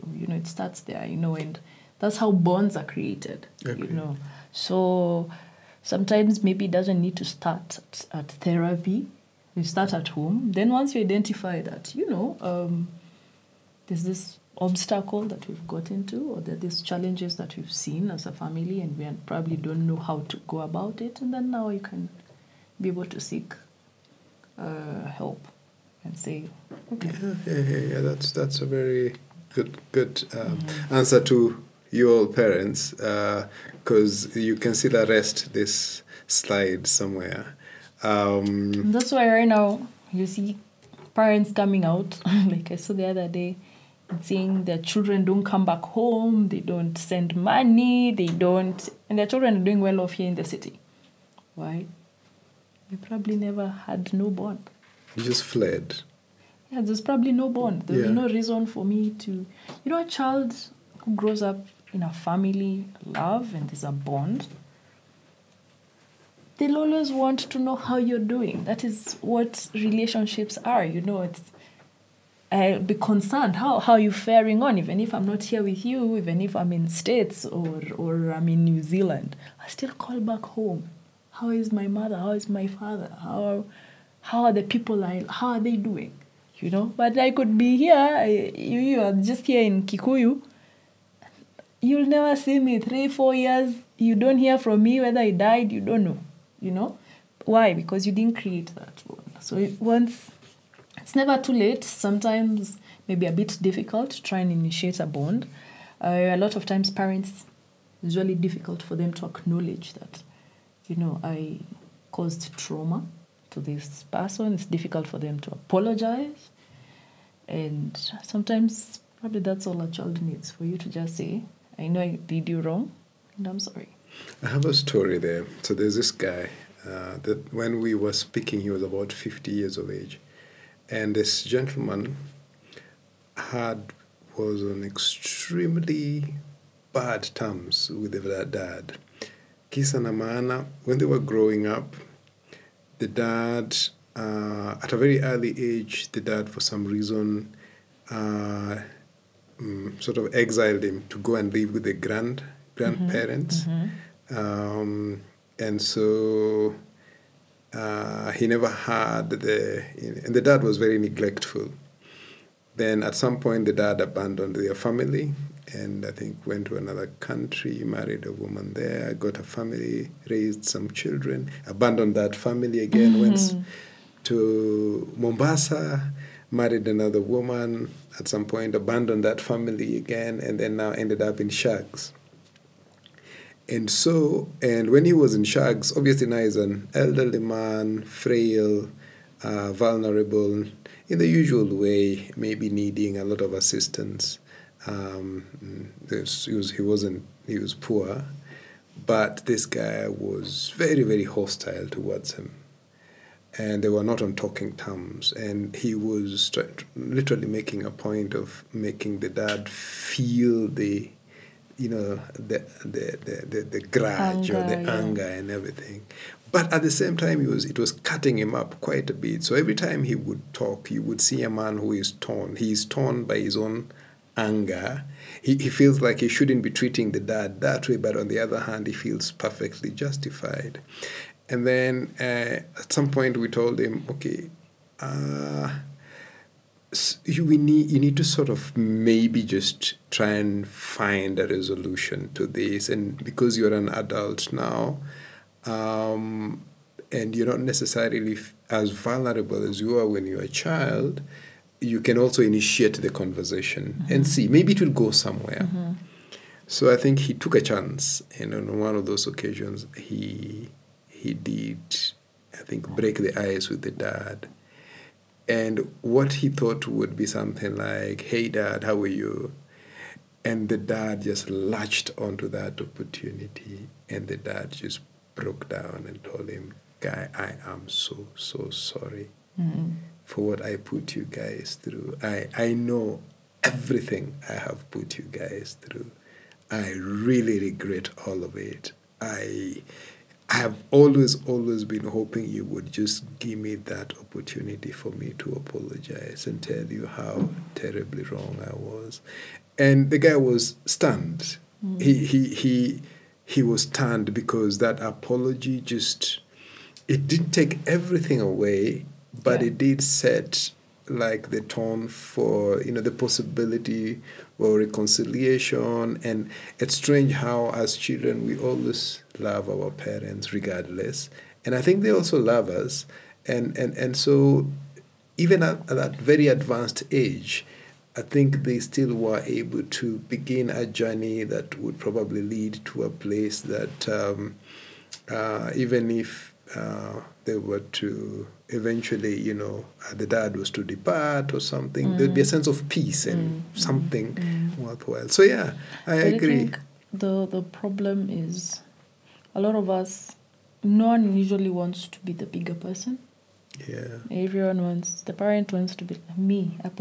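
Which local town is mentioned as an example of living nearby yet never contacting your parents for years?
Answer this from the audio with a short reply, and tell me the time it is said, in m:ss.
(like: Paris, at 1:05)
Kikuyu, at 1:29.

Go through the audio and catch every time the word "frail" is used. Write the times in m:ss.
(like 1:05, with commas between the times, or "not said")
3:08.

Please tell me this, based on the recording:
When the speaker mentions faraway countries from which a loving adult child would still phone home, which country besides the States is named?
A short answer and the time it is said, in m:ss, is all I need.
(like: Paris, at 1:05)
New Zealand, at 1:18.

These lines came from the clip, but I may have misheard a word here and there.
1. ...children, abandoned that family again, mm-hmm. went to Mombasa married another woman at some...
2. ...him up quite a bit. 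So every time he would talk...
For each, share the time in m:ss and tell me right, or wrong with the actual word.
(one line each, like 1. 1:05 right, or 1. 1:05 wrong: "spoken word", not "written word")
1. 2:50 right
2. 3:38 right.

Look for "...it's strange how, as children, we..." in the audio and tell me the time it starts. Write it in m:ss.
5:16.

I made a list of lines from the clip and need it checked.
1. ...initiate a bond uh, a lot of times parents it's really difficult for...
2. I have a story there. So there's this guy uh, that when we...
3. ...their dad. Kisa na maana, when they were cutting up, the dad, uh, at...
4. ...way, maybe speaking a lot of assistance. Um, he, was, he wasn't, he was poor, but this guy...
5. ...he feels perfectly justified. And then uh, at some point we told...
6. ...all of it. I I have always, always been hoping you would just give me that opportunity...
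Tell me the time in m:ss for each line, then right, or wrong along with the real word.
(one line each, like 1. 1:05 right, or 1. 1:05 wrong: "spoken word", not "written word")
1. 1:44 right
2. 2:04 right
3. 2:18 wrong: "growing", not "cutting"
4. 3:11 wrong: "needing", not "speaking"
5. 3:48 right
6. 4:48 right.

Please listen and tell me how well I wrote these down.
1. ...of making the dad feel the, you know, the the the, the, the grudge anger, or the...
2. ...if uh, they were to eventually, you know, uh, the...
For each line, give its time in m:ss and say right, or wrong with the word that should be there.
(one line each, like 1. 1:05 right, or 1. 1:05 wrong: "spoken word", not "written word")
1. 3:28 right
2. 5:36 right.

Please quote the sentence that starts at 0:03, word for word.
You know, so sometimes maybe it doesn't need to start at, at therapy.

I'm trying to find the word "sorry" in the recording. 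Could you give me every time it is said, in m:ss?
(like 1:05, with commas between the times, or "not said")
2:03, 4:38.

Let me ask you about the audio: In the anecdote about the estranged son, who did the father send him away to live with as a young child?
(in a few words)
grandparents.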